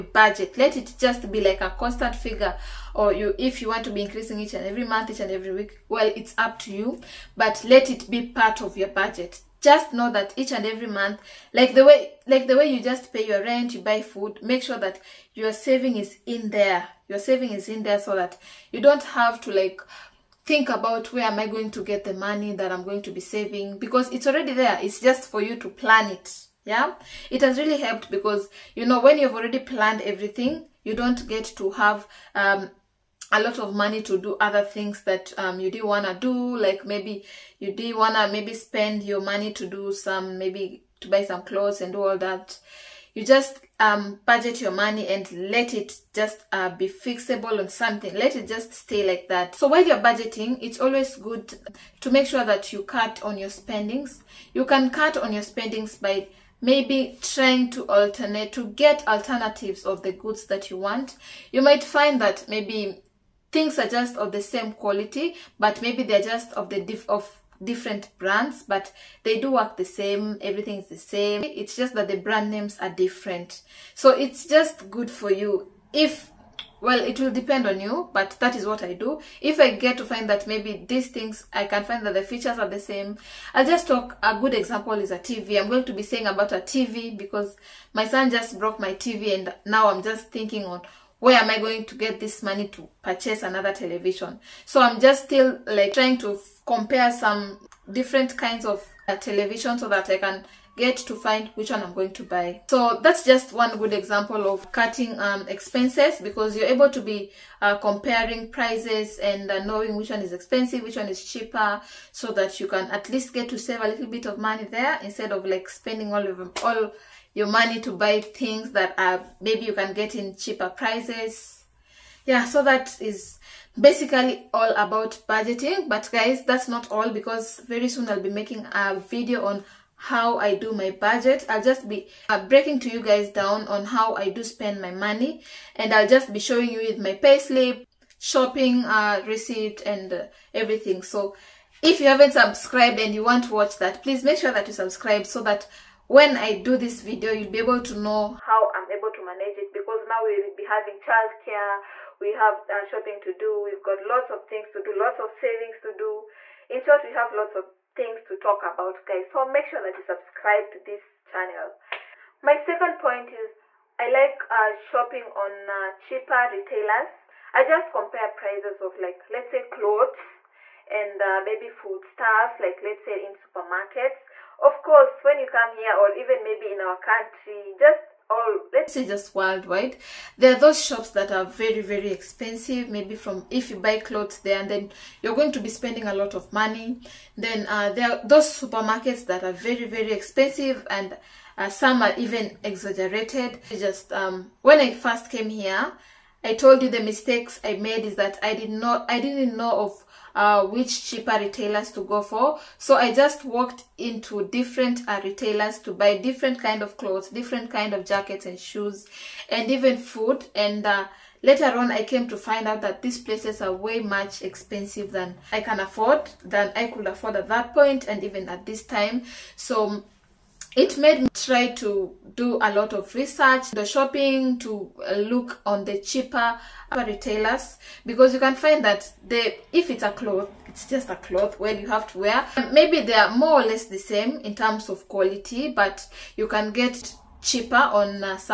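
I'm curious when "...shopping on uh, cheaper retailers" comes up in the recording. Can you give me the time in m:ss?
2:44.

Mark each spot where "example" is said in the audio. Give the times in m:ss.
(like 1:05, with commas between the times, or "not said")
1:24, 1:43.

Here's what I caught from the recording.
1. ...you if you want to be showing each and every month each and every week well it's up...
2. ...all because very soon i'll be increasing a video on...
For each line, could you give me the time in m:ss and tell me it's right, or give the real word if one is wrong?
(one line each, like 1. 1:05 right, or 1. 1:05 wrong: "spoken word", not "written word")
1. 0:03 wrong: "increasing", not "showing"
2. 2:06 wrong: "making", not "increasing".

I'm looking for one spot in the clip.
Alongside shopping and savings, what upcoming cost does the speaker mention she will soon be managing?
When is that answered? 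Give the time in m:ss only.
2:30.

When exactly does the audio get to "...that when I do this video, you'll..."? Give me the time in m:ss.
2:25.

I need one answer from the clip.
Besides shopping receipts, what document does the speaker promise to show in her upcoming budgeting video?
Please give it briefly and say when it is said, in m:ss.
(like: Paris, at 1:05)
Payslip, at 2:17.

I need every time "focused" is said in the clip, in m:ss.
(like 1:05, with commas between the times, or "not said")
not said.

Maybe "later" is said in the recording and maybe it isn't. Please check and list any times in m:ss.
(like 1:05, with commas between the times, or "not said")
3:31.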